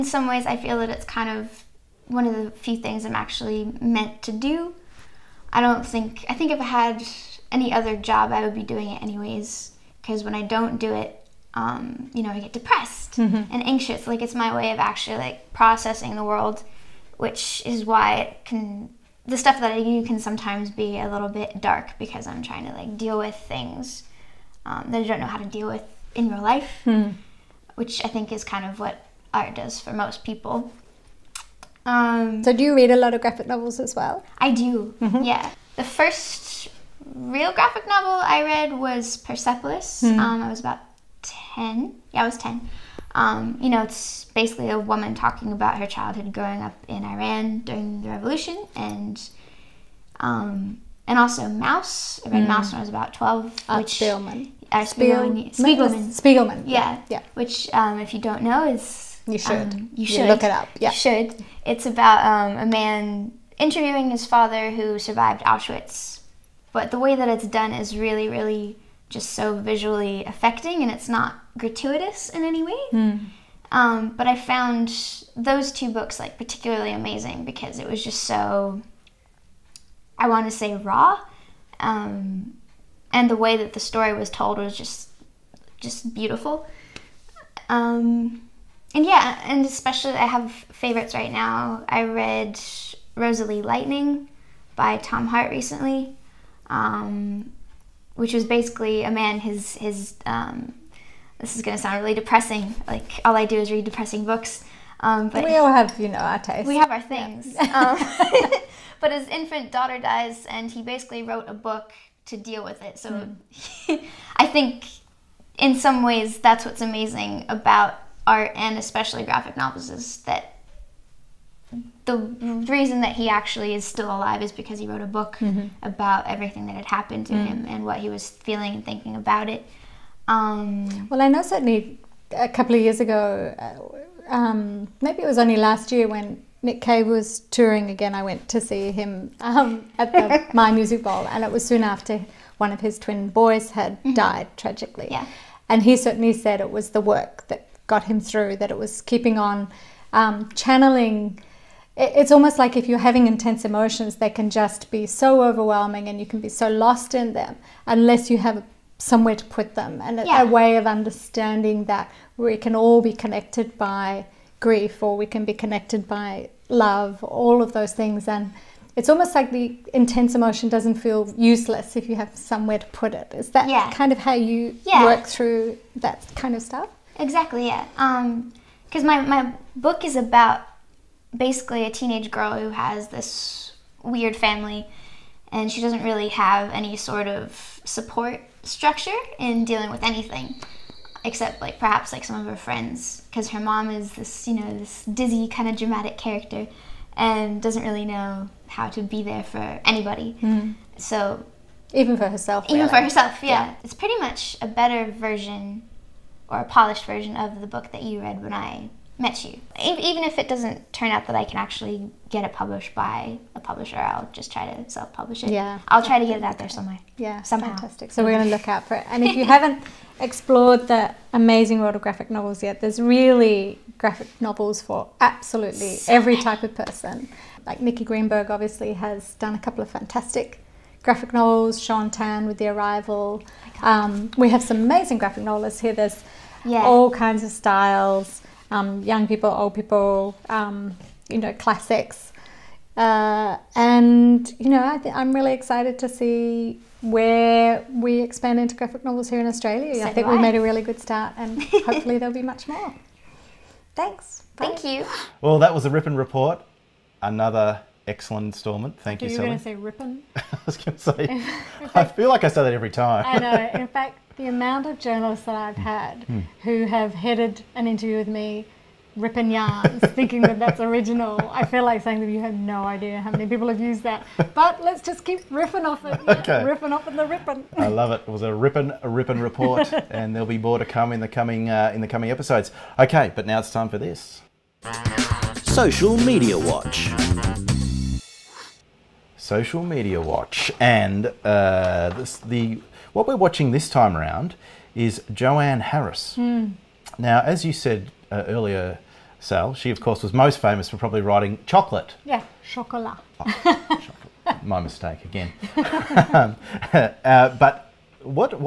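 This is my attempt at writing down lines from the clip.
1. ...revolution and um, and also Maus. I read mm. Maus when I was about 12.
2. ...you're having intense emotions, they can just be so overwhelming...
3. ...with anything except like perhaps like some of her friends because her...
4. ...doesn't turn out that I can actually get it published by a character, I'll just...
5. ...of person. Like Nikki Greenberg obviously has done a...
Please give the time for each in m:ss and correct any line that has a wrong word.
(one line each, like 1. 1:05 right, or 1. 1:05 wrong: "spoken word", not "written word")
1. 0:48 right
2. 2:32 right
3. 3:09 right
4. 3:30 wrong: "publisher", not "character"
5. 3:46 right.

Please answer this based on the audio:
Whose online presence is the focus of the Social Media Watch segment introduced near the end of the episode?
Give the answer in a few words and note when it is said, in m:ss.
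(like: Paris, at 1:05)
Joanne Harris, at 4:55.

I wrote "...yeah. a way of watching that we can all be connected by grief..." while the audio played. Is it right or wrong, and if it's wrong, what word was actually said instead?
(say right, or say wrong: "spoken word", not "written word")
wrong: "understanding", not "watching".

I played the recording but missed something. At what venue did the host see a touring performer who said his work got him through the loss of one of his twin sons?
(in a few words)
Myer Music Bowl.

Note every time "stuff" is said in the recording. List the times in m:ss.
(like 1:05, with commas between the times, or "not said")
0:19, 2:56.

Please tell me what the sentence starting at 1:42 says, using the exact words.
Like all I do is read depressing books.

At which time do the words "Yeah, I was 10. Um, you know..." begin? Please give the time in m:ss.
0:42.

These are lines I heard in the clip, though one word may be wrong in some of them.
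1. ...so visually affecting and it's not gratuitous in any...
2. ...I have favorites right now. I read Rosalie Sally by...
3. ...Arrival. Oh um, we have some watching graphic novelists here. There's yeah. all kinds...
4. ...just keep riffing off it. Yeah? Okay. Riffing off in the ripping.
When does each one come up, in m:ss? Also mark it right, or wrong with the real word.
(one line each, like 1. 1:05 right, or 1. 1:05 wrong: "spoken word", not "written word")
1. 1:09 right
2. 1:30 wrong: "Lightning", not "Sally"
3. 3:52 wrong: "amazing", not "watching"
4. 4:35 right.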